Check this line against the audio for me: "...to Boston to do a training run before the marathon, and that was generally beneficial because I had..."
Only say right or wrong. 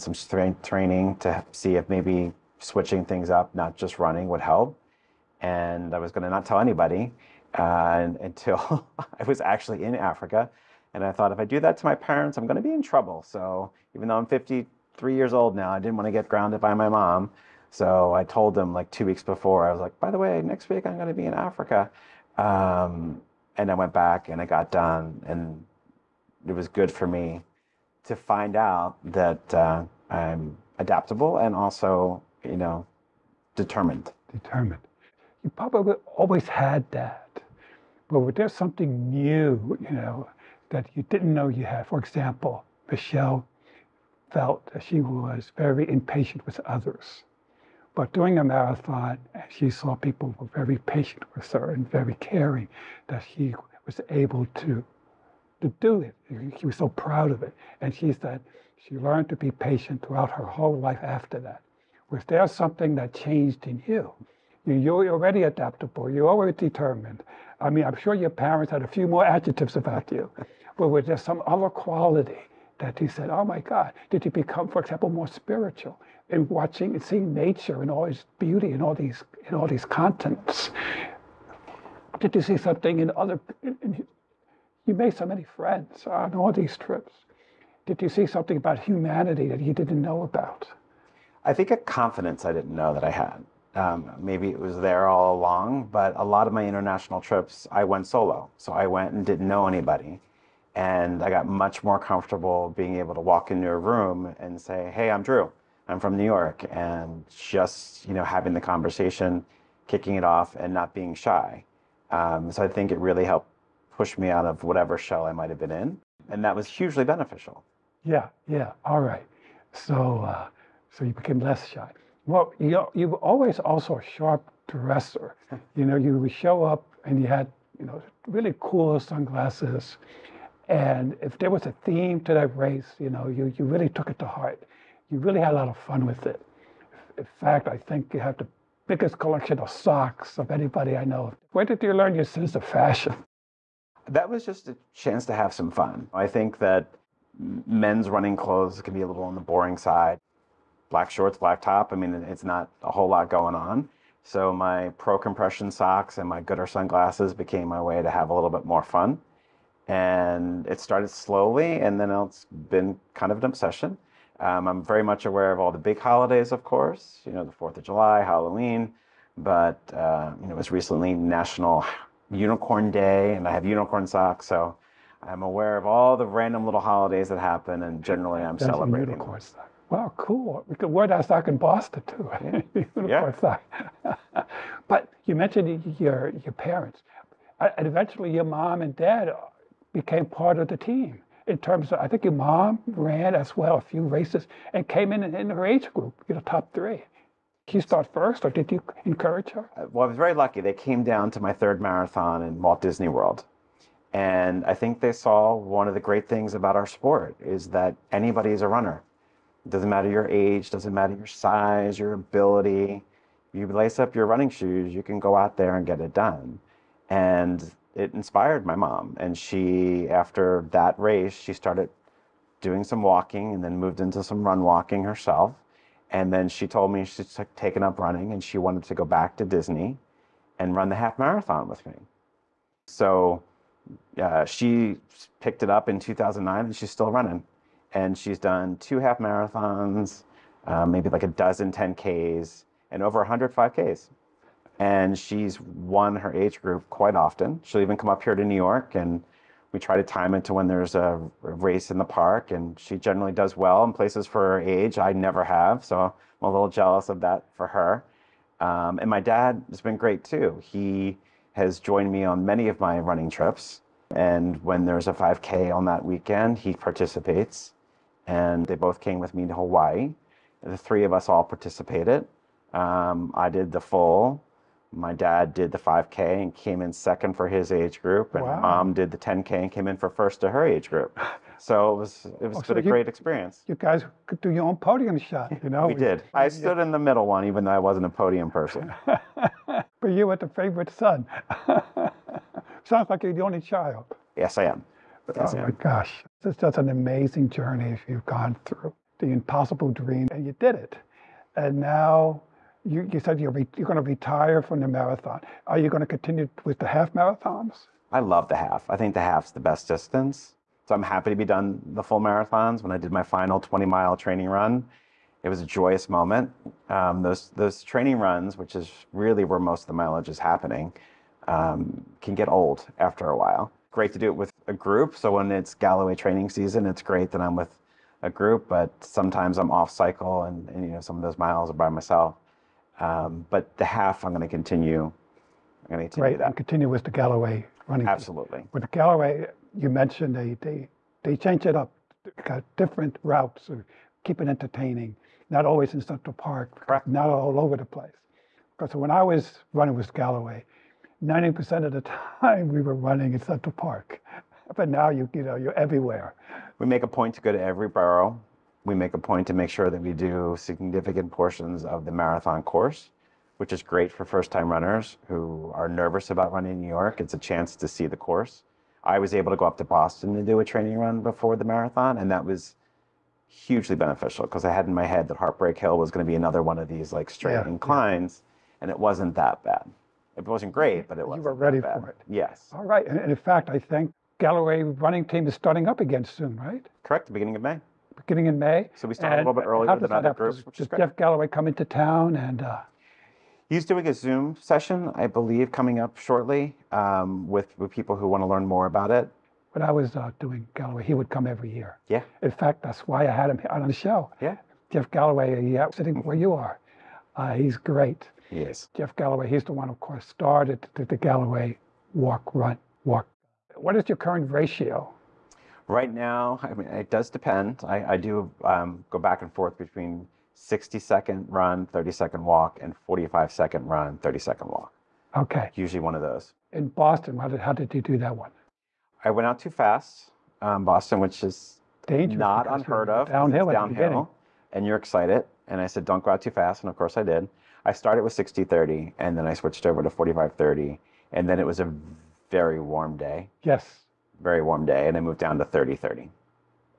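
wrong.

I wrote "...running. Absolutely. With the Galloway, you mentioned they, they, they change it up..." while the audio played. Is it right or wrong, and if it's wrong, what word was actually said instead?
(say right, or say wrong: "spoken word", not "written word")
right.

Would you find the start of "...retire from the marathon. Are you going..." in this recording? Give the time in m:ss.
5:04.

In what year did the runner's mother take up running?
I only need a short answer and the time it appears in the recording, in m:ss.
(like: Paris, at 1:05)
2009, at 3:55.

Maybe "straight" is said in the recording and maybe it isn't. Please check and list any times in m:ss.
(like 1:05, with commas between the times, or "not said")
6:17.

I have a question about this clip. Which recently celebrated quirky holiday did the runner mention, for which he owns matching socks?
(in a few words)
National Unicorn Day.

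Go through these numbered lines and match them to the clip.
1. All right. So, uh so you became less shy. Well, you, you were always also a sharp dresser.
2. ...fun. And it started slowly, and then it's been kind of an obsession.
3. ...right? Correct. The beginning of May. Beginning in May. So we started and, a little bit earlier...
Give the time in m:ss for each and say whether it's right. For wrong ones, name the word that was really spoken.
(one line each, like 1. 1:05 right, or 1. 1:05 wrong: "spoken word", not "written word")
1. 1:58 right
2. 2:38 right
3. 6:26 right.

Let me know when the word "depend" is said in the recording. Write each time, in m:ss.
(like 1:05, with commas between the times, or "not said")
6:57.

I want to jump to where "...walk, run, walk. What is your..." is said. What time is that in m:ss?
6:52.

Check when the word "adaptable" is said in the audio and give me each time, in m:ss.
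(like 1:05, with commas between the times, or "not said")
0:30, 1:05.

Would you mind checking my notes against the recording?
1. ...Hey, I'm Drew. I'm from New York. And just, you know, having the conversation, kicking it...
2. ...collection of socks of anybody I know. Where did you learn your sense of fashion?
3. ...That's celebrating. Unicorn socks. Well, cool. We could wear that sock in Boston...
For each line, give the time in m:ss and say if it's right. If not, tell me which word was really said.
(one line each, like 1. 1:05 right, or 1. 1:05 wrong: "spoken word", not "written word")
1. 1:44 right
2. 2:19 right
3. 2:58 right.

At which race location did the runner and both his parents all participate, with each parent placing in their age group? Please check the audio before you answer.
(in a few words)
Hawaii.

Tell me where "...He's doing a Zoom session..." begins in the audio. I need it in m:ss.
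6:33.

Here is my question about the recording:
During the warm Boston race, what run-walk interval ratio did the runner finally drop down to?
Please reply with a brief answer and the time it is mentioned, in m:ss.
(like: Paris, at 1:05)
30/30, at 7:25.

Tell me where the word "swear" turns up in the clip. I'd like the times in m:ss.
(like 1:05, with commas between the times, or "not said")
not said.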